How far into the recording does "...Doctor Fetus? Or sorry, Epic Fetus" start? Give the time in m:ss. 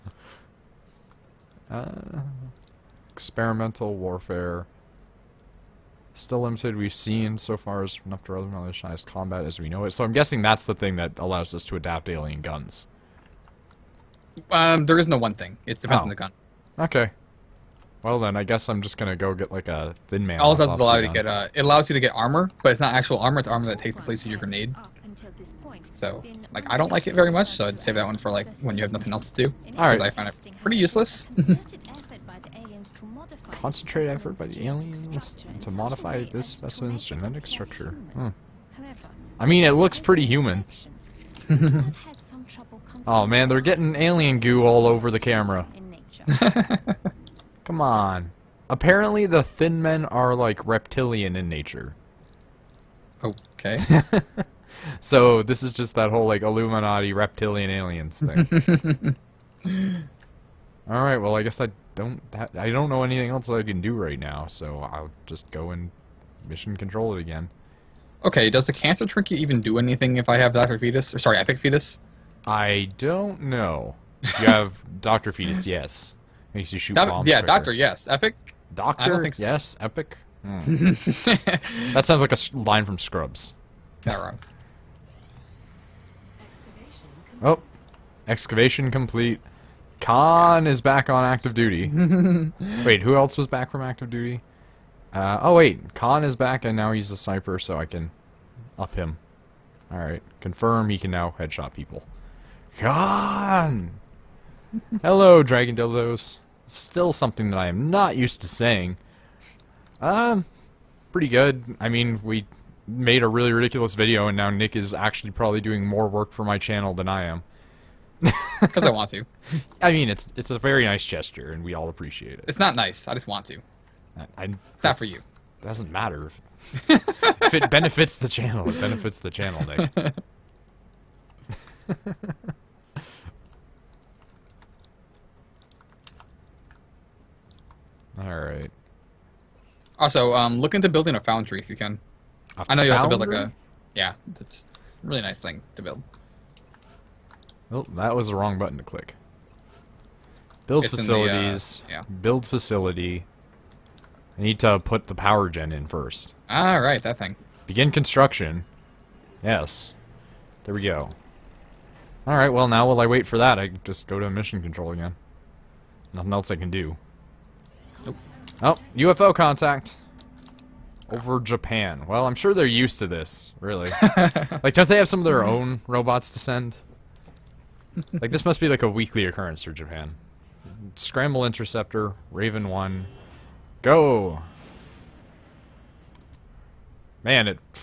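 1:10.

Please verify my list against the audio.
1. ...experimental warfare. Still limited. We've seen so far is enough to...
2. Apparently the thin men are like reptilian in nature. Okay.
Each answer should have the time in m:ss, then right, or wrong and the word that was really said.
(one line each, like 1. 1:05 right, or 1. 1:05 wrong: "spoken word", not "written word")
1. 0:03 right
2. 0:48 right.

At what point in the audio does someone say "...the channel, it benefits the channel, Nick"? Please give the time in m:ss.
2:08.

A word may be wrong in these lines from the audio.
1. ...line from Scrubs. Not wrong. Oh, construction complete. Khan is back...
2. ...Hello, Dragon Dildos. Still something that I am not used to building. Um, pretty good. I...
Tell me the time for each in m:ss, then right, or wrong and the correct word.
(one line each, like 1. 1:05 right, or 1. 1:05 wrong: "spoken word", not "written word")
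1. 1:22 wrong: "excavation", not "construction"
2. 1:45 wrong: "saying", not "building".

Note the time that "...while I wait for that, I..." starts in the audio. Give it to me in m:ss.
2:42.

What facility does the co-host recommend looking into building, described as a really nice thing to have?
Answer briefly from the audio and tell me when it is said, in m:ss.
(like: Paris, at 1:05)
A foundry, at 2:21.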